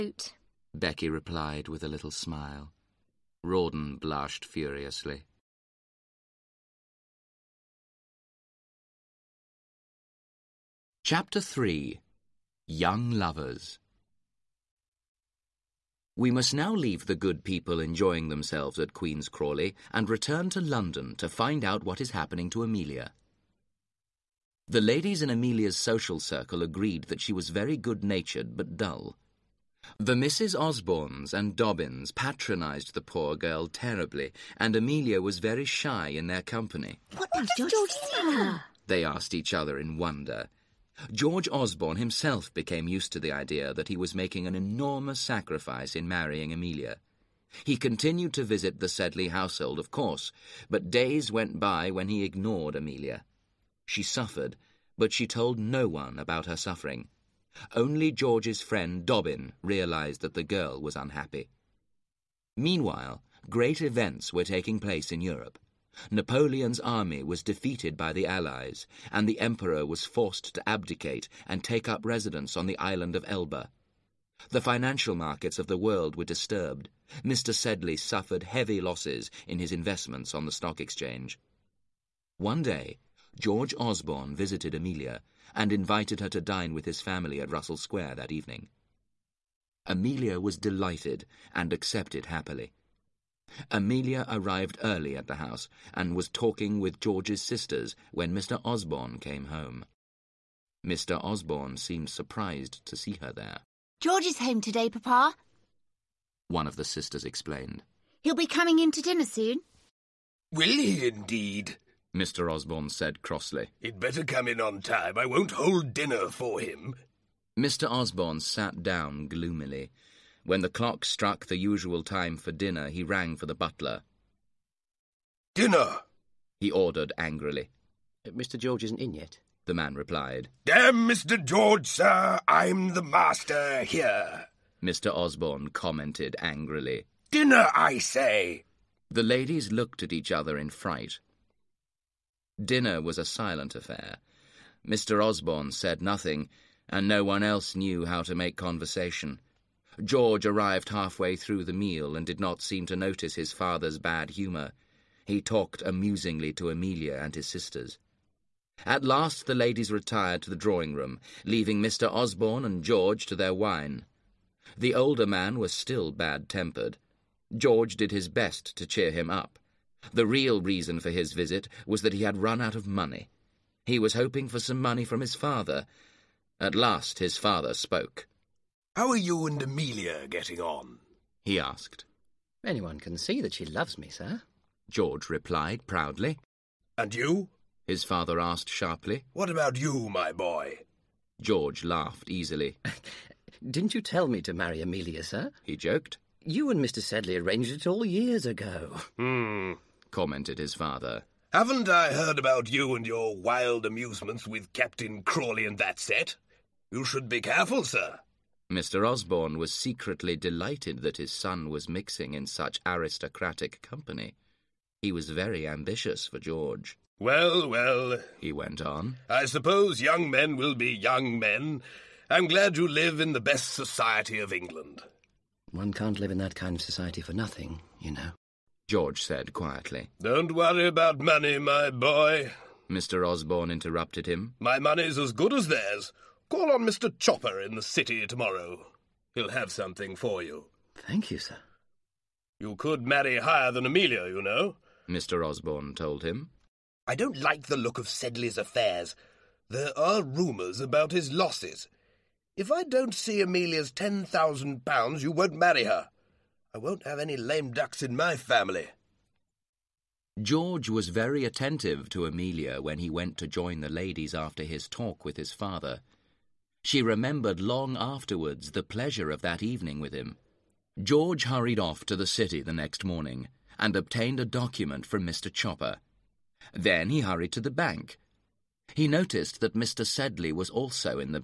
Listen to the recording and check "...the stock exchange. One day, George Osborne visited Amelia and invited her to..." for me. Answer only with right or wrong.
right.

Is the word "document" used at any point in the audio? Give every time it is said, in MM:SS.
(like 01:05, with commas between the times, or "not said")
04:34.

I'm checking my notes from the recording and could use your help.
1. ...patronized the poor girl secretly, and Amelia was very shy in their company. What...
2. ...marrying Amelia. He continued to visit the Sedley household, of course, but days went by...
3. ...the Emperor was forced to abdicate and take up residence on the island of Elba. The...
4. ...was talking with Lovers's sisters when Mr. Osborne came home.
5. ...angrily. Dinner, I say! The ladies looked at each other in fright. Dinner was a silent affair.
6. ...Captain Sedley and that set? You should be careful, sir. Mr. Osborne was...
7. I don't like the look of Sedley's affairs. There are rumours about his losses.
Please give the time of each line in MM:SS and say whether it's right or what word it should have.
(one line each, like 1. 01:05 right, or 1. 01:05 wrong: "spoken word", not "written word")
1. 00:32 wrong: "terribly", not "secretly"
2. 00:46 right
3. 01:09 right
4. 01:36 wrong: "George", not "Lovers"
5. 02:16 right
6. 03:24 wrong: "Crawley", not "Sedley"
7. 04:07 right.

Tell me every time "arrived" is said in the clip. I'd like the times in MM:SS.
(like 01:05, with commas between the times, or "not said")
01:34, 02:30.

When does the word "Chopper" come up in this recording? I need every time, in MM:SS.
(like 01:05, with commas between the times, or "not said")
03:57, 04:35.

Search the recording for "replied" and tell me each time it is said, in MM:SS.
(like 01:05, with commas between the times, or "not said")
00:01, 02:09, 03:05.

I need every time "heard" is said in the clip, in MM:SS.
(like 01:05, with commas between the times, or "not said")
03:22.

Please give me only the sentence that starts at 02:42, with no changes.
Osborne and George to their wine.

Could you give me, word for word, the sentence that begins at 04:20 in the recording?
George was very attentive to Amelia when he went to join the ladies after his talk with his father.